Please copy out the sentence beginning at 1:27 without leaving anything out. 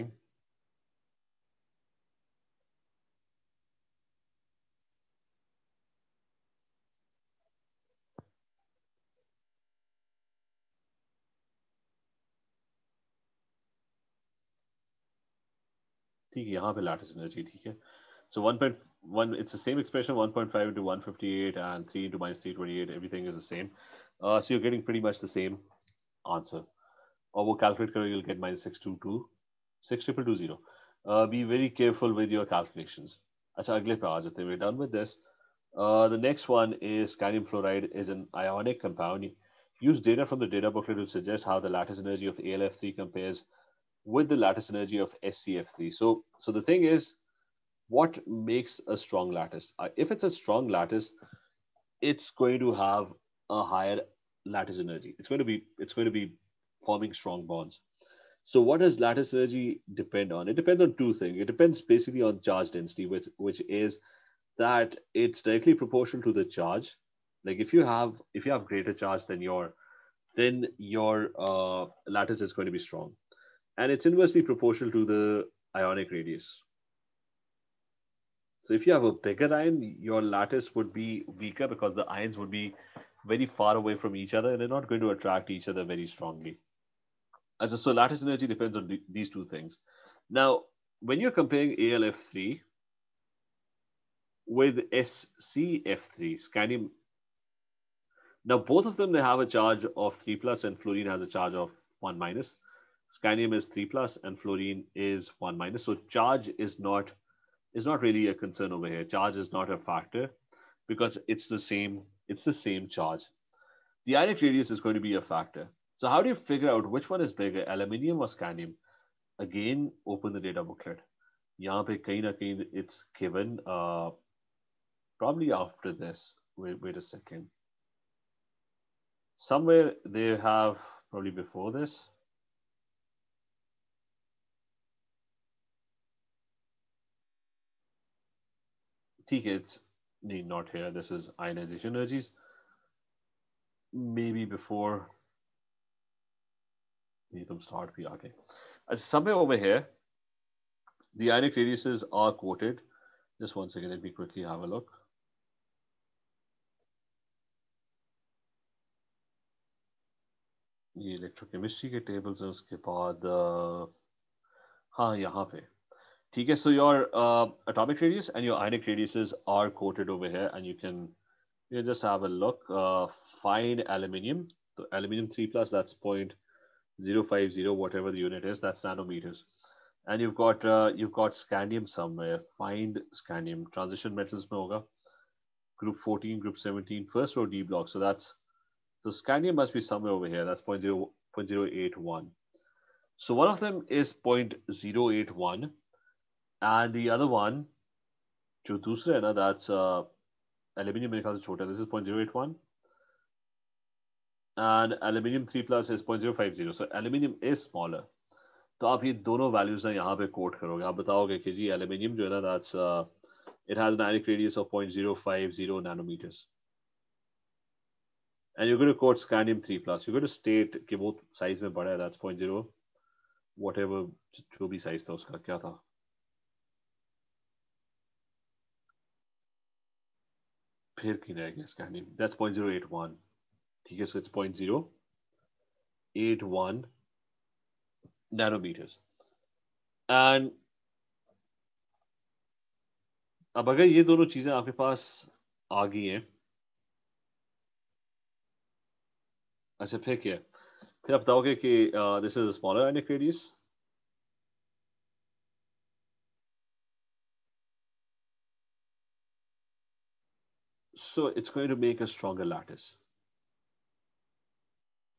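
As a, so lattice energy depends on these two things.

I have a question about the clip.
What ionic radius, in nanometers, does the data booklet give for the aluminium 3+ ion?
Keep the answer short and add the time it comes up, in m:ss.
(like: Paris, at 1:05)
0.050, at 2:55.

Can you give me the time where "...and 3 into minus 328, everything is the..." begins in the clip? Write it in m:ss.
0:21.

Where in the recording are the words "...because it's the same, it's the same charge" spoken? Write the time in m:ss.
1:50.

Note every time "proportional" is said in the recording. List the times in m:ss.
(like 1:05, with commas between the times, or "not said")
1:05, 1:14.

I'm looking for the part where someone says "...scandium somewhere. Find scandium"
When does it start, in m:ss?
3:01.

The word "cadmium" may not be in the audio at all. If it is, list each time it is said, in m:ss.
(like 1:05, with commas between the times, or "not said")
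0:37.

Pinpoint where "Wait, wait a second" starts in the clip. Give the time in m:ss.
2:06.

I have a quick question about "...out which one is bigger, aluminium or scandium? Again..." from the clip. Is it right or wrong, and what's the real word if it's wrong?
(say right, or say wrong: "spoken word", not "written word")
right.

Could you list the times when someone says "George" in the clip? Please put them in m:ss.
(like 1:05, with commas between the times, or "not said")
not said.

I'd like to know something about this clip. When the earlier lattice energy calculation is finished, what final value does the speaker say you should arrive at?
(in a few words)
-622.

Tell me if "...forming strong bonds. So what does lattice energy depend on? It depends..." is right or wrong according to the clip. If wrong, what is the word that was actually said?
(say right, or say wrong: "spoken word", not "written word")
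right.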